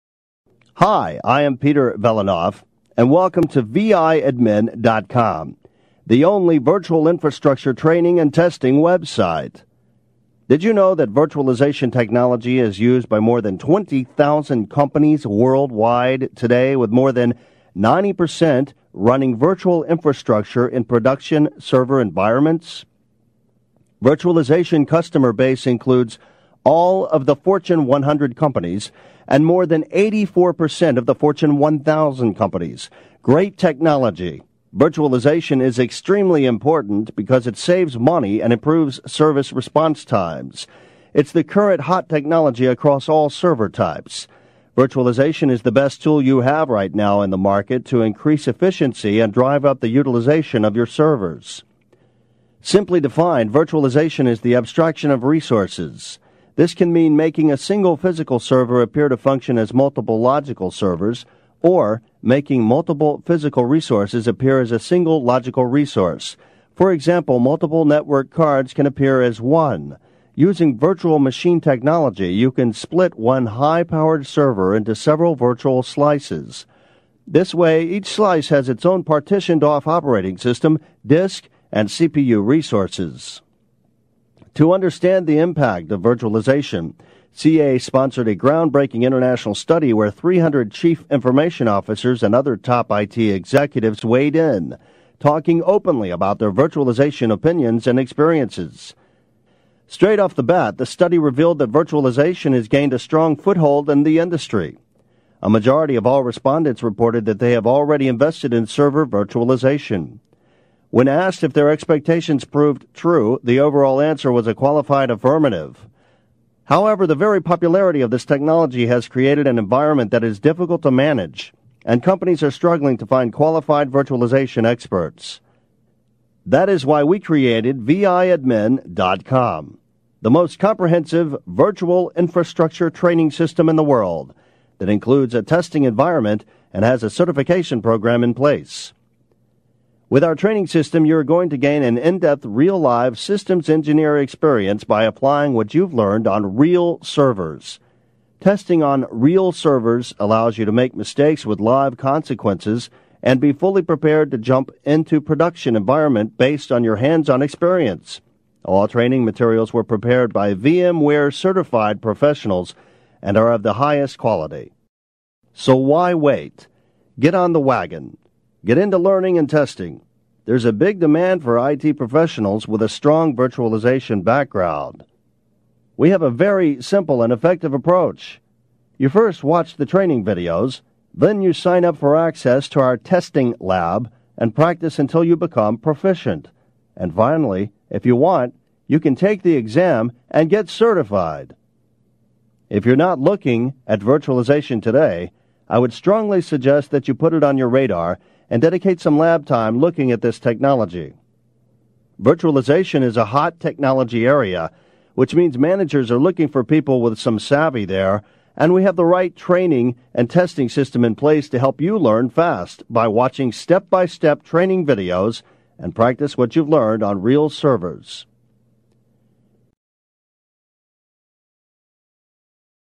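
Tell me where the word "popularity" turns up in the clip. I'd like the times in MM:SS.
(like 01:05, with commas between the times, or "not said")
01:57.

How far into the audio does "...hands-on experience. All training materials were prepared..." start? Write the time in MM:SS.
02:36.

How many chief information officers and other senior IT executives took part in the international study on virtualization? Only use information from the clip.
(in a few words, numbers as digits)
300.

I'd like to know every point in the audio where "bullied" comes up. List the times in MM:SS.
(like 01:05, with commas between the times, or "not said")
not said.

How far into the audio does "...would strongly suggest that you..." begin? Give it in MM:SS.
03:15.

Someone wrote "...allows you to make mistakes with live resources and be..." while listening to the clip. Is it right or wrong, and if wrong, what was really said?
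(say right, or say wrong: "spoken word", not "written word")
wrong: "consequences", not "resources".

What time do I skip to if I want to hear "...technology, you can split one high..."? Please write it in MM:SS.
01:11.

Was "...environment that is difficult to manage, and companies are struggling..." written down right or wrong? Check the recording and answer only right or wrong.
right.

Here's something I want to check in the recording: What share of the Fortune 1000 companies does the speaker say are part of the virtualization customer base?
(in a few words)
84%.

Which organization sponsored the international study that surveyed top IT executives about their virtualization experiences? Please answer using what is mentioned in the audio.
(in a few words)
CA.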